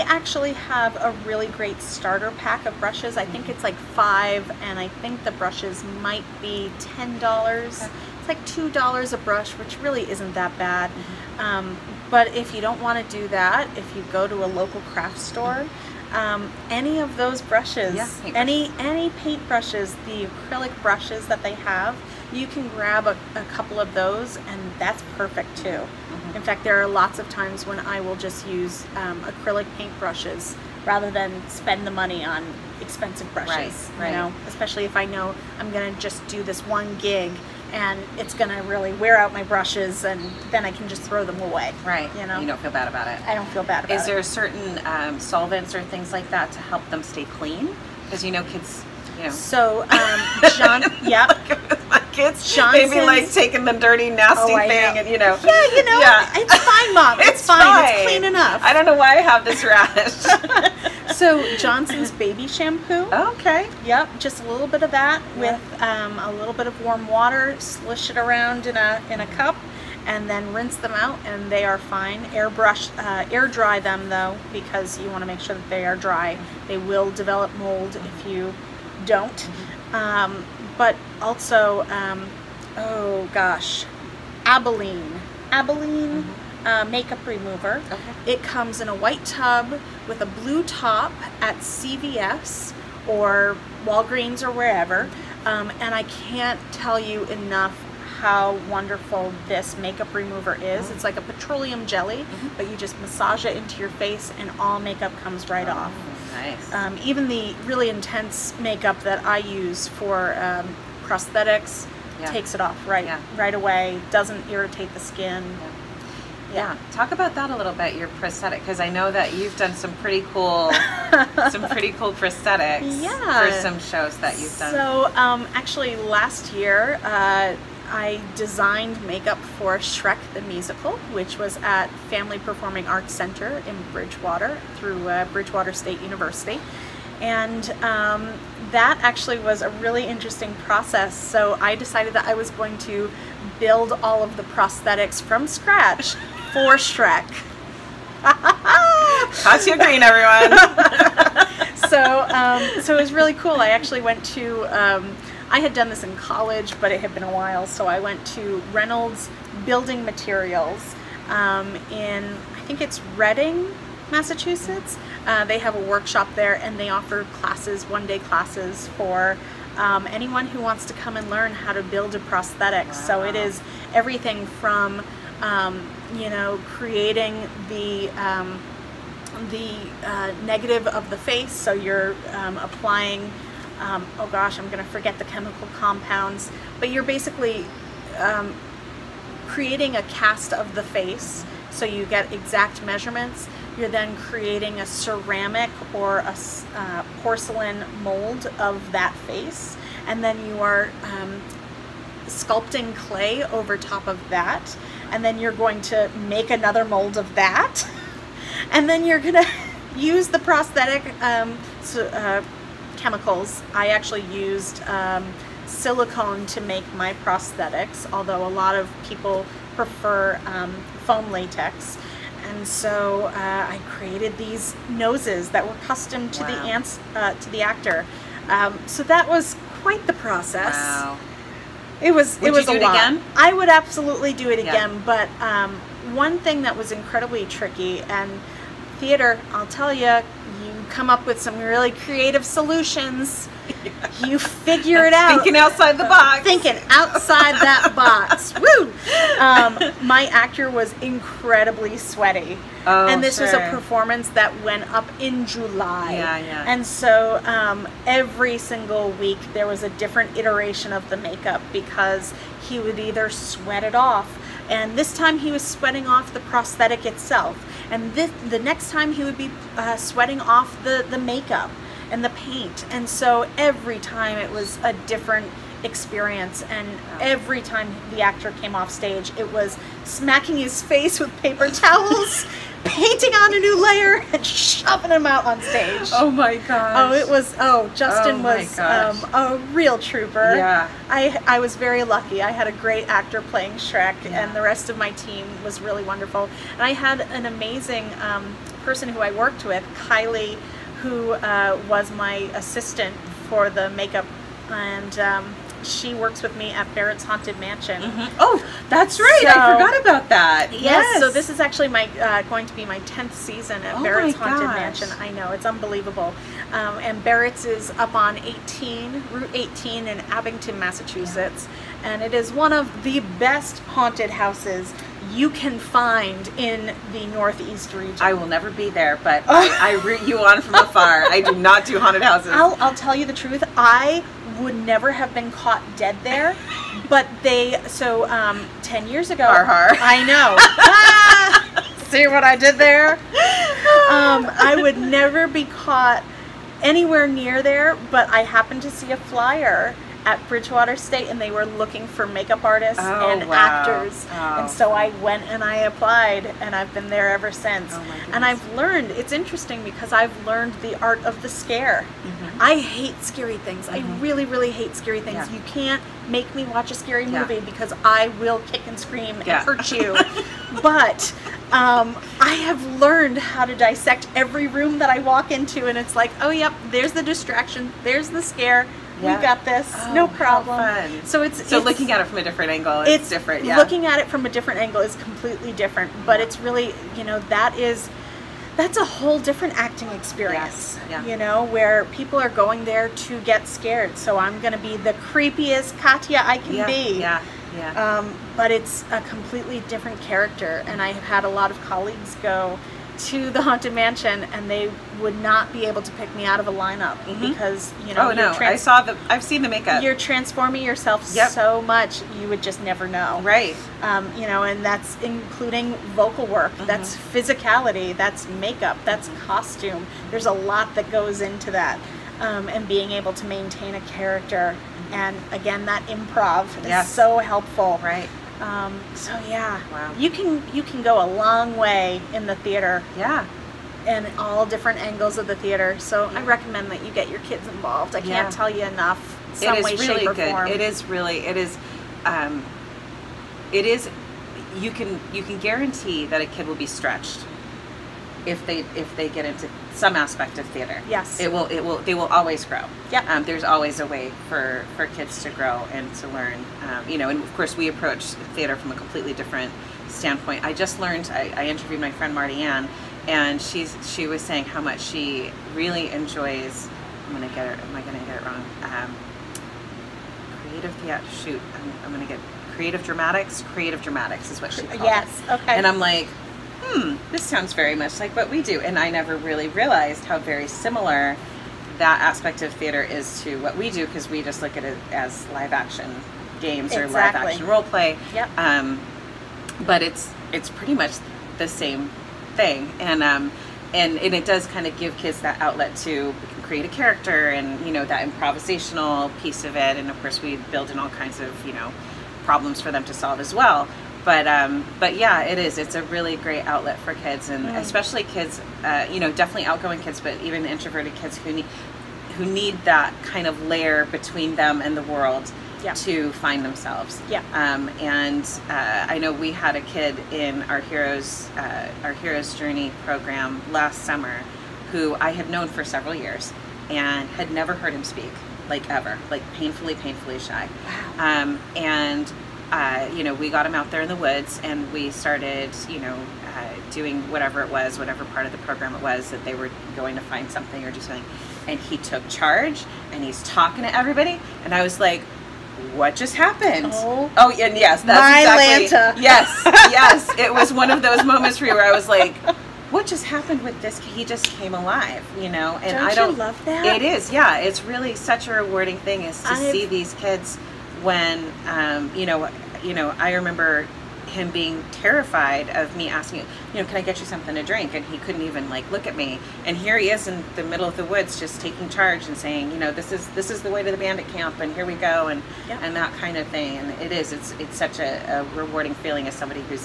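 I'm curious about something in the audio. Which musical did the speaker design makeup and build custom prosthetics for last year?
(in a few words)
Shrek the Musical.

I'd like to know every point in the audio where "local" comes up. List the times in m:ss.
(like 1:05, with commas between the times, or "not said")
0:14.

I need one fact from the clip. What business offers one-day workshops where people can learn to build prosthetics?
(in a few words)
Reynolds Building Materials.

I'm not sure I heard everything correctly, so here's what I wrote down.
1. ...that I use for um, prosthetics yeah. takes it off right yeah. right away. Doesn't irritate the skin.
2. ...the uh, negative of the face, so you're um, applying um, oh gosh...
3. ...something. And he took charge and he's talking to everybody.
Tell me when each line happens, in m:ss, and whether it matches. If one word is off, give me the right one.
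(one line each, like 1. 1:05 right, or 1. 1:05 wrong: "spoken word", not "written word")
1. 1:49 right
2. 2:59 right
3. 9:01 right.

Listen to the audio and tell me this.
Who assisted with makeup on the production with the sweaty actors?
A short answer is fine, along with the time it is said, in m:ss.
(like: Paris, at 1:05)
Kylie, at 4:59.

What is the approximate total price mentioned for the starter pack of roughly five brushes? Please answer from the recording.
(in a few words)
$10.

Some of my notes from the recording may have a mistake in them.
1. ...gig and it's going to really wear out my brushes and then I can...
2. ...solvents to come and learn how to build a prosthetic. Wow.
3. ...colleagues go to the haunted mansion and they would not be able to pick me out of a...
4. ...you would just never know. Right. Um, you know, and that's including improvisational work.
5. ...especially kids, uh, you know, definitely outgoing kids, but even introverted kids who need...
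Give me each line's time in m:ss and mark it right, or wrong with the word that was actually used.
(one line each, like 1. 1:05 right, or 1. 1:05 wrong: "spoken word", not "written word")
1. 0:37 right
2. 2:50 wrong: "wants", not "solvents"
3. 6:41 right
4. 6:52 wrong: "vocal", not "improvisational"
5. 8:27 right.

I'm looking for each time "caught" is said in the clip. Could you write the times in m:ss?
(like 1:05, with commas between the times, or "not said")
5:35, 5:45.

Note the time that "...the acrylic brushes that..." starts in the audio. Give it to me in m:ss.
0:20.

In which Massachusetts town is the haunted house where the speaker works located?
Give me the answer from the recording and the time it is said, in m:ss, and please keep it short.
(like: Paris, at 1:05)
Abington, at 5:20.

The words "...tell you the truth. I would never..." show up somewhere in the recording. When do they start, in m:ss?
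5:32.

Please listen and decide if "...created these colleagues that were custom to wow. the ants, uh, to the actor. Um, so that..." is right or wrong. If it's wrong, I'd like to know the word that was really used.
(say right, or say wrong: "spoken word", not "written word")
wrong: "noses", not "colleagues".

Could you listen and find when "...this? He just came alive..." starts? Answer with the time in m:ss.
9:13.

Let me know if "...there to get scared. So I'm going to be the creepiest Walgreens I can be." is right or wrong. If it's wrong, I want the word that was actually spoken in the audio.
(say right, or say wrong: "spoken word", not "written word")
wrong: "Katia", not "Walgreens".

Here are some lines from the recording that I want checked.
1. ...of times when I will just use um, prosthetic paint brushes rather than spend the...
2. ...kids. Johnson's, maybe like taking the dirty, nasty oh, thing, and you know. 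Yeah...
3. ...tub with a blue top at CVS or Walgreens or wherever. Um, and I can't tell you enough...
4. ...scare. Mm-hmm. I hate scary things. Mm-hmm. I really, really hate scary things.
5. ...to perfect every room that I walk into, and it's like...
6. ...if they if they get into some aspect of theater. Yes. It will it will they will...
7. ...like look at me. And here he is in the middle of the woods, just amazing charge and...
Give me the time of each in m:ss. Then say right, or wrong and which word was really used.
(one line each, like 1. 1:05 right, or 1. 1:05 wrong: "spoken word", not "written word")
1. 0:27 wrong: "acrylic", not "prosthetic"
2. 0:52 right
3. 1:29 right
4. 6:01 right
5. 6:13 wrong: "dissect", not "perfect"
6. 7:28 right
7. 9:28 wrong: "taking", not "amazing".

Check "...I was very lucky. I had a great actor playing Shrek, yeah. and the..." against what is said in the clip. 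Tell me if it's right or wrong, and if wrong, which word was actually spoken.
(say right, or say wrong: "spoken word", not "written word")
right.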